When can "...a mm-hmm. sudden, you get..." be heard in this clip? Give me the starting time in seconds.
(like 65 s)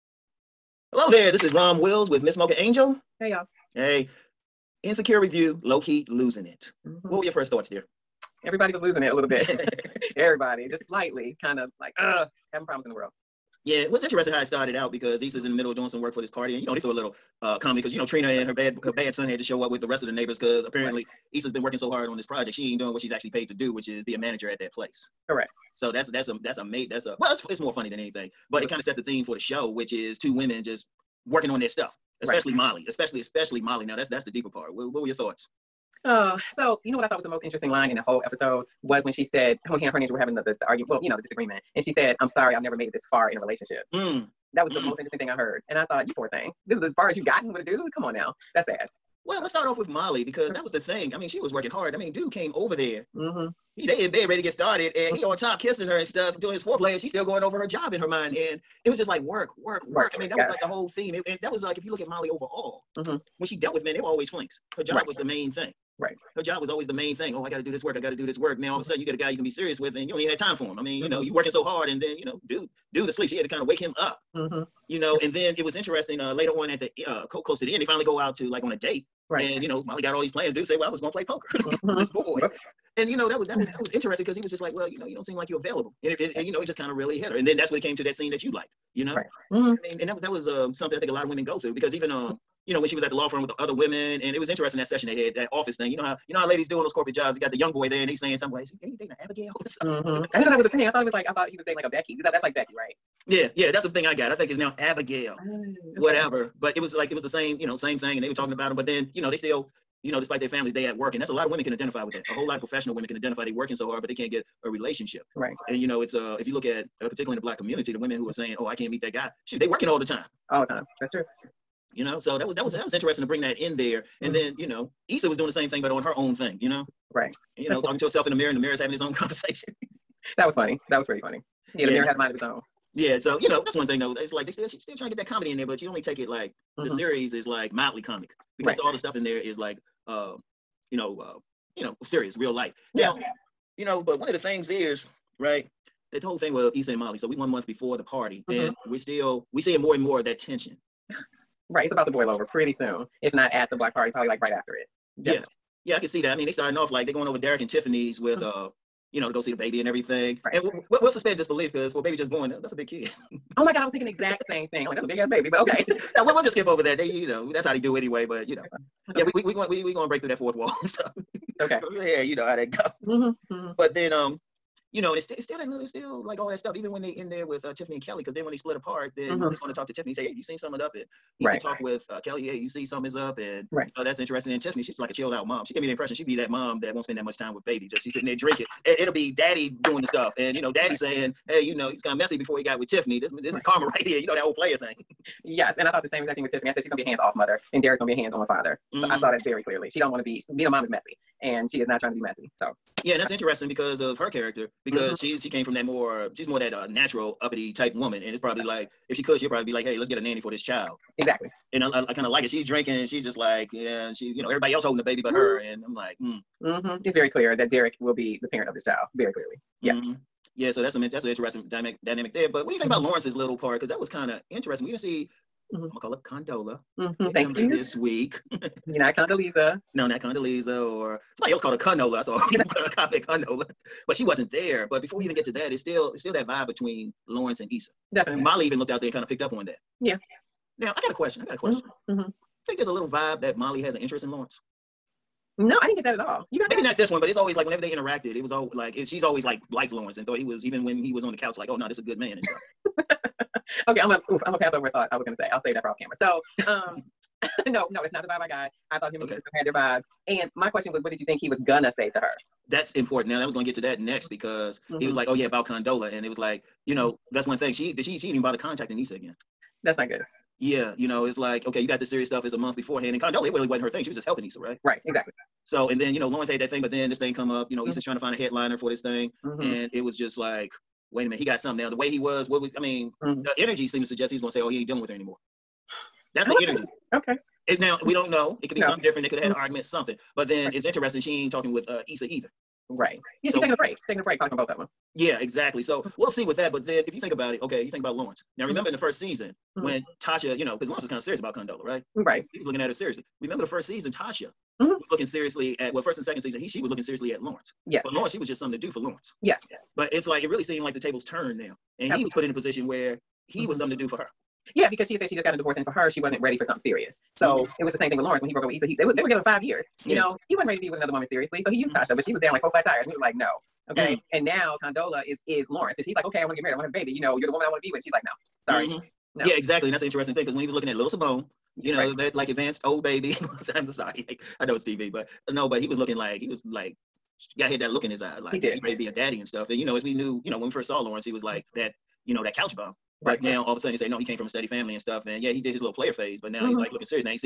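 68 s.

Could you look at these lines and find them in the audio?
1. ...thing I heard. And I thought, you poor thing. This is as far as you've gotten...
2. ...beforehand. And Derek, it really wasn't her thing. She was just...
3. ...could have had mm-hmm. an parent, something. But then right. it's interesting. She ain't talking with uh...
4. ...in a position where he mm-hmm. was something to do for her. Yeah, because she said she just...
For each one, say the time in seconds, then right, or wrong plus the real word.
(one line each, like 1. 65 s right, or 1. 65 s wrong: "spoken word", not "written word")
1. 45 s right
2. 272 s wrong: "Condola", not "Derek"
3. 289 s wrong: "argument", not "parent"
4. 312 s right.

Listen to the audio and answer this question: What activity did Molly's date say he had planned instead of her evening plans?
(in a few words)
Poker.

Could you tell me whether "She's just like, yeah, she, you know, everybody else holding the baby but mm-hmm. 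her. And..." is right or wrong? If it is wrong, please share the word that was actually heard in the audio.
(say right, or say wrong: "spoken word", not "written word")
right.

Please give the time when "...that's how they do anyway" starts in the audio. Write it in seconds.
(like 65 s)
167 s.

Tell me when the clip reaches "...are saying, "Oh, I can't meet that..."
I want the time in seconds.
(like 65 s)
118 s.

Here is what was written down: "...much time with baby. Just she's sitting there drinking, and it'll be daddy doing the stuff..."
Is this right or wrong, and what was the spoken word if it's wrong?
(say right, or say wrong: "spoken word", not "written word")
right.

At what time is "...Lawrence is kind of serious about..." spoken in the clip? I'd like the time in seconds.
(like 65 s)
300 s.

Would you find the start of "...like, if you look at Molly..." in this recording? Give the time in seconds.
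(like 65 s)
61 s.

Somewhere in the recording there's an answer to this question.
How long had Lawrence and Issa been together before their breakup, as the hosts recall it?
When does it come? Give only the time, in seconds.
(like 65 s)
319 s.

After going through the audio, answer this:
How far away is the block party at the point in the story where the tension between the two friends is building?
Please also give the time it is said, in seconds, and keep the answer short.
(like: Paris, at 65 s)
1 month, at 147 s.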